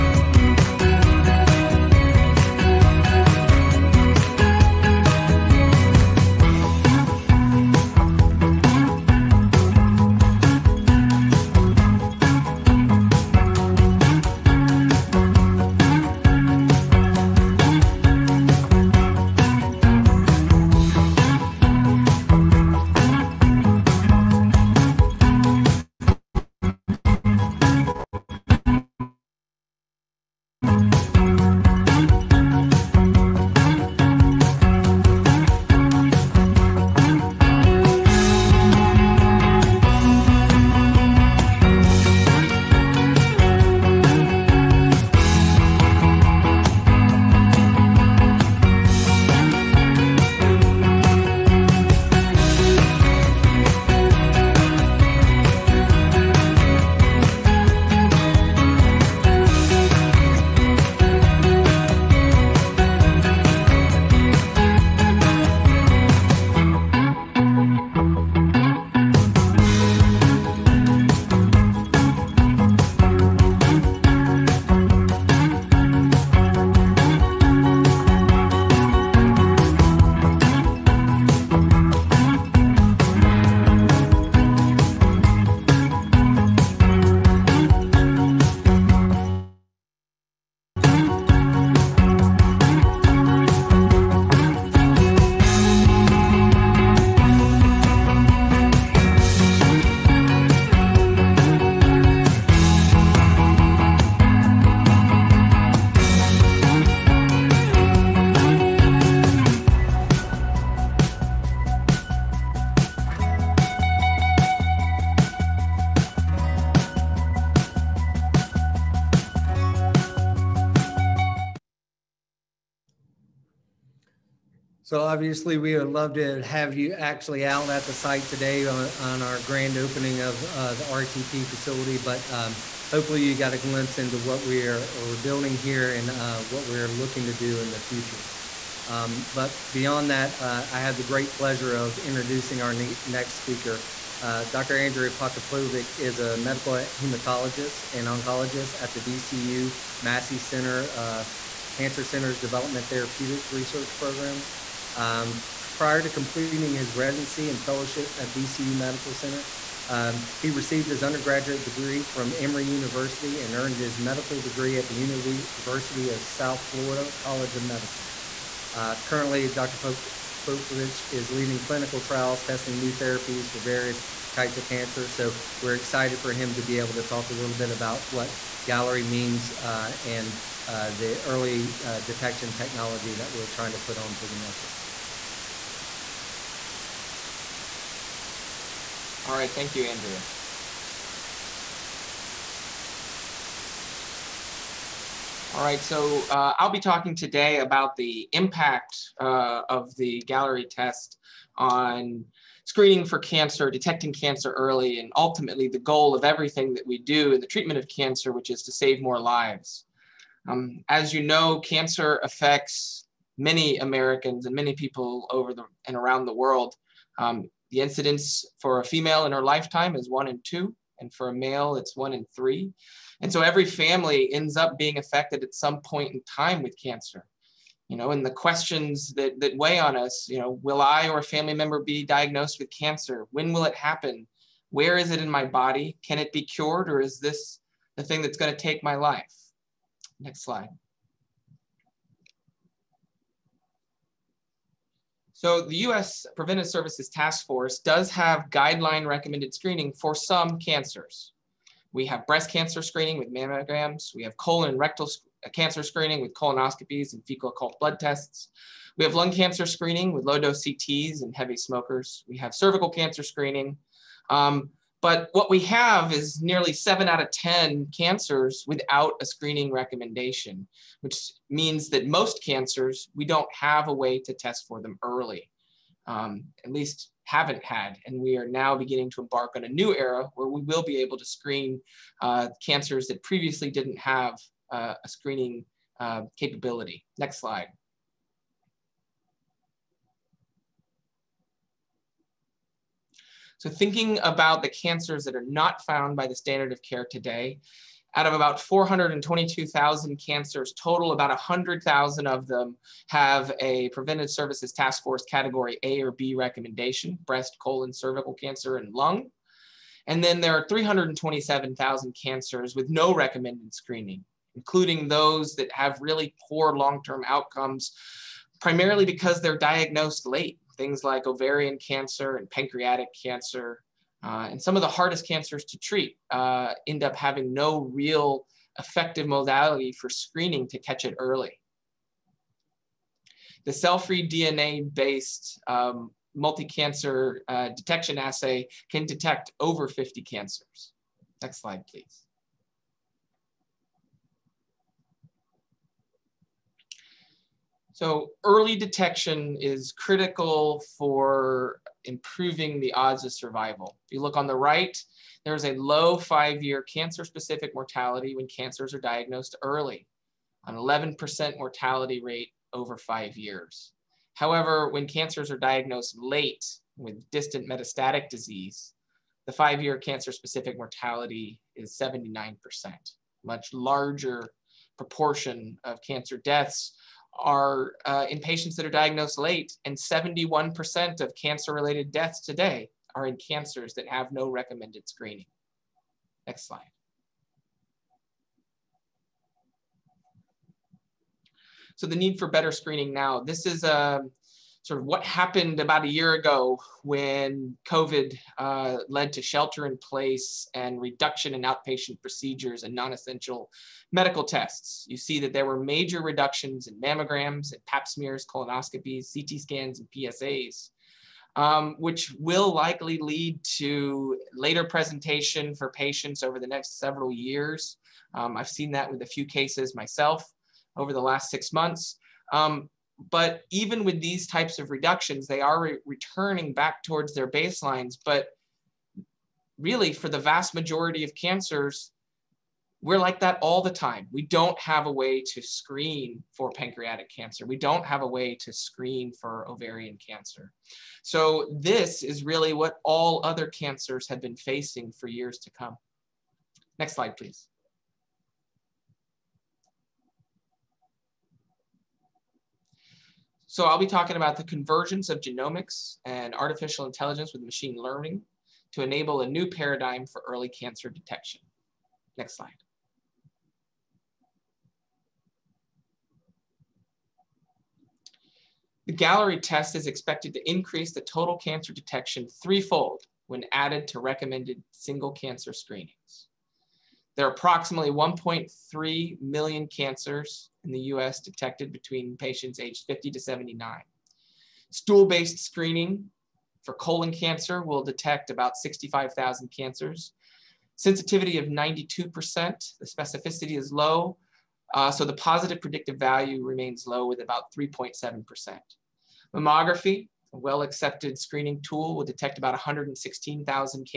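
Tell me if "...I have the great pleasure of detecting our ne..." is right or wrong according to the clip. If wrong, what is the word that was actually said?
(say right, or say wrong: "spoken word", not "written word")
wrong: "introducing", not "detecting".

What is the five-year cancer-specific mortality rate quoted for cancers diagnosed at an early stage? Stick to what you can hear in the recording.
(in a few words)
11%.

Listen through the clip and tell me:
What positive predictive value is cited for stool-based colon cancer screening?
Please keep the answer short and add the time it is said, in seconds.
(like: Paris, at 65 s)
3.7%, at 497 s.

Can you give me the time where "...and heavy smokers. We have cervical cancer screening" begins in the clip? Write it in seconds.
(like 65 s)
261 s.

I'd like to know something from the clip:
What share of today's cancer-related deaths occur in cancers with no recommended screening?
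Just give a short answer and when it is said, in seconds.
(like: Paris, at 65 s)
71%, at 379 s.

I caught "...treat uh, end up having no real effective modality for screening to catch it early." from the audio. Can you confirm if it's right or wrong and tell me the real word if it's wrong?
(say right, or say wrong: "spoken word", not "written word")
right.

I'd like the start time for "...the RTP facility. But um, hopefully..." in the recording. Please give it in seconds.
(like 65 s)
130 s.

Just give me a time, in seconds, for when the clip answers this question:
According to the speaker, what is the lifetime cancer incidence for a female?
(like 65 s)
220 s.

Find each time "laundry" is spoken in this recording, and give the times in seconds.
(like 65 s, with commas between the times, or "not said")
not said.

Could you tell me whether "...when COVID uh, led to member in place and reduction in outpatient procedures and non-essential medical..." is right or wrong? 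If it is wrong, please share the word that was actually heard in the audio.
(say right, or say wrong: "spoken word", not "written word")
wrong: "shelter", not "member".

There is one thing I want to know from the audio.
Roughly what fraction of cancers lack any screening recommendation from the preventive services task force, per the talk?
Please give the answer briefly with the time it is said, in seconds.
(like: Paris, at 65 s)
7 out of 10, at 266 s.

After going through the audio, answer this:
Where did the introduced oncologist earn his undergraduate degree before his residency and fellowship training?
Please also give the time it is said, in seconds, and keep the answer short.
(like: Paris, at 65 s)
Emory University, at 162 s.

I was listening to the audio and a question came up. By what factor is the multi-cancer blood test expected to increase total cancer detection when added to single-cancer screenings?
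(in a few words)
threefold.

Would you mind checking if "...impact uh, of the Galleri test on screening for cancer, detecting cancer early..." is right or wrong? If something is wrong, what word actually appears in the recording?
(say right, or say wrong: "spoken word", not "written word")
right.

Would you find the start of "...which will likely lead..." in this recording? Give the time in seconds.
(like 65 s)
411 s.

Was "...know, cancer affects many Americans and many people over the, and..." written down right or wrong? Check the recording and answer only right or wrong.
right.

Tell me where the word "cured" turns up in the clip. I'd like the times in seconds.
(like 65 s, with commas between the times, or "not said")
236 s.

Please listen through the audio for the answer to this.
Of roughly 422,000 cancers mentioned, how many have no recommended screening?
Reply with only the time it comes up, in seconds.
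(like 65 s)
310 s.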